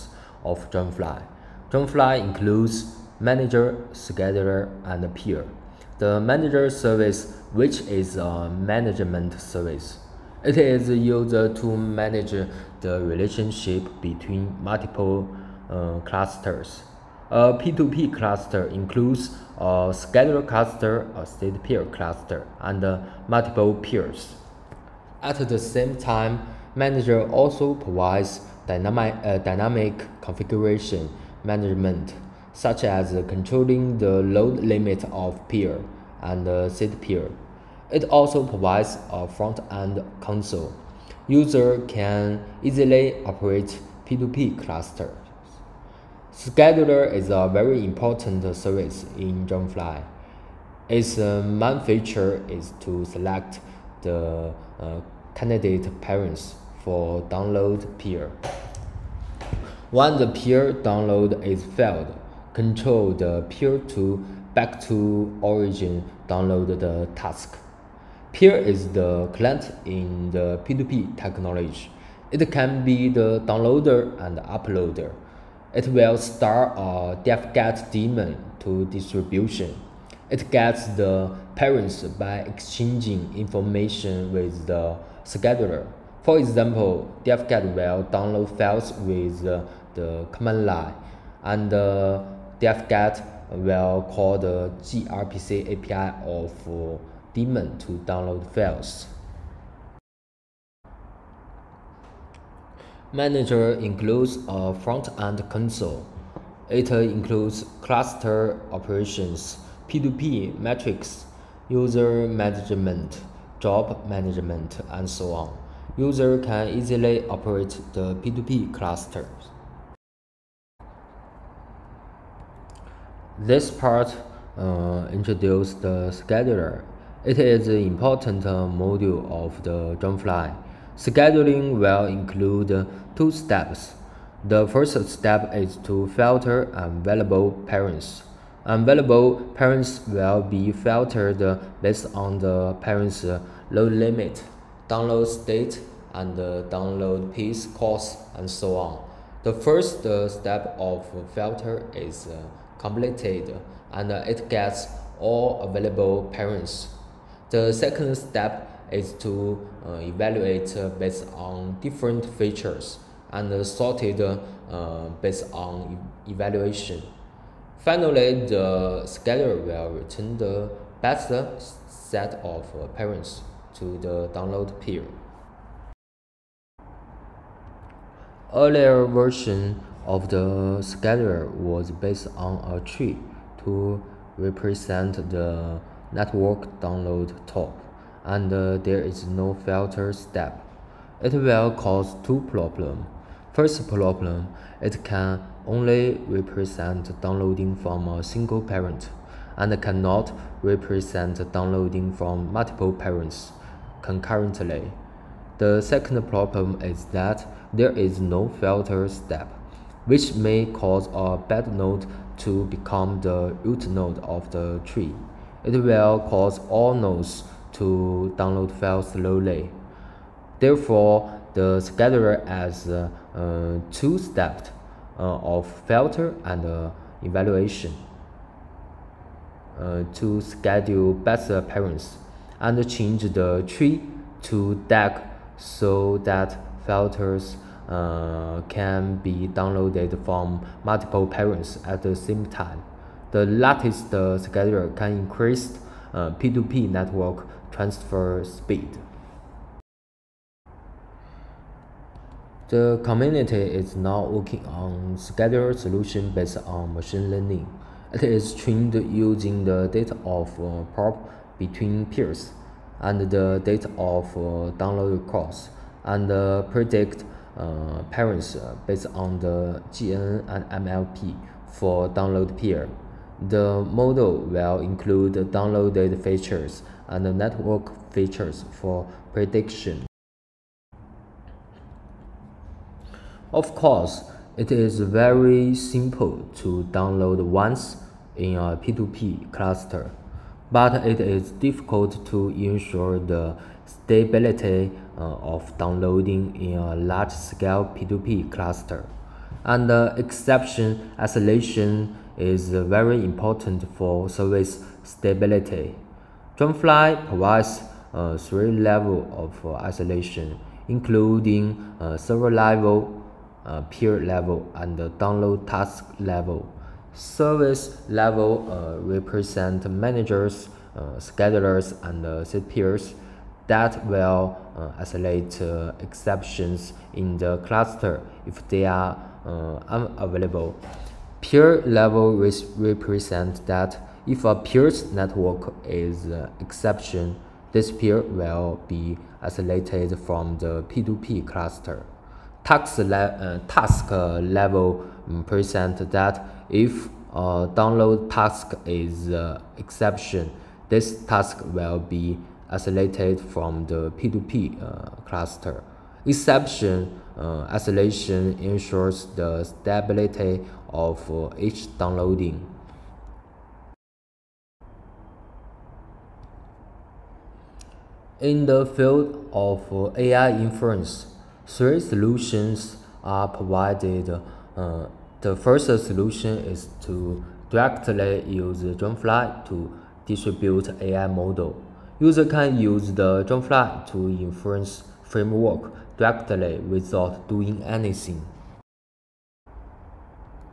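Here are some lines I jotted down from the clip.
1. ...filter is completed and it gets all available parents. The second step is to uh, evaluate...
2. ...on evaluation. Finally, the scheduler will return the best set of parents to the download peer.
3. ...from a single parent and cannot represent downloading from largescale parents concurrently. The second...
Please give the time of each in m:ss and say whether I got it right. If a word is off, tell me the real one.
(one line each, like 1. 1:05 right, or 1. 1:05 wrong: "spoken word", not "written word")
1. 2:31 right
2. 2:45 right
3. 3:17 wrong: "multiple", not "largescale".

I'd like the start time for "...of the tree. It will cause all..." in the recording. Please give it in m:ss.
3:34.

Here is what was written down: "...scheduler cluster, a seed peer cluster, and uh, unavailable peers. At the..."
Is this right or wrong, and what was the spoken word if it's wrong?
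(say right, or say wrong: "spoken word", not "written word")
wrong: "multiple", not "unavailable".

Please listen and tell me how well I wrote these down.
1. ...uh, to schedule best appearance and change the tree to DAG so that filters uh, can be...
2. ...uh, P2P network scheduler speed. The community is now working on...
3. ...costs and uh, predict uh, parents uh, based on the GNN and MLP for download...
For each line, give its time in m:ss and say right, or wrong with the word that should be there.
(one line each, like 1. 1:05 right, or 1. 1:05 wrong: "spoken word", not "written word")
1. 3:49 right
2. 4:06 wrong: "transfer", not "scheduler"
3. 4:25 right.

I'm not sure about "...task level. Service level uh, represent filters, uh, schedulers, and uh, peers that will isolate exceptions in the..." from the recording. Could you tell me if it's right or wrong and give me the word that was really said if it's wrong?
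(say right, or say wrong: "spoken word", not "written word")
wrong: "managers", not "filters".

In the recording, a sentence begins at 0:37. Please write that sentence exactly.
It also provides a front-end console.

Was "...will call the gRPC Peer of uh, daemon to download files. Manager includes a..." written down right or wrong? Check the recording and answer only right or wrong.
wrong.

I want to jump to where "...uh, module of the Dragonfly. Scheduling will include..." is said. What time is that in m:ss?
2:08.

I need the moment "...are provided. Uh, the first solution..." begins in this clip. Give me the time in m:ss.
6:13.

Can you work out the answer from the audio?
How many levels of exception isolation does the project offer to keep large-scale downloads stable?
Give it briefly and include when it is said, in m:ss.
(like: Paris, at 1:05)
3, at 5:08.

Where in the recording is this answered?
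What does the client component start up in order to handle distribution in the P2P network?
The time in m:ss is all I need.
1:17.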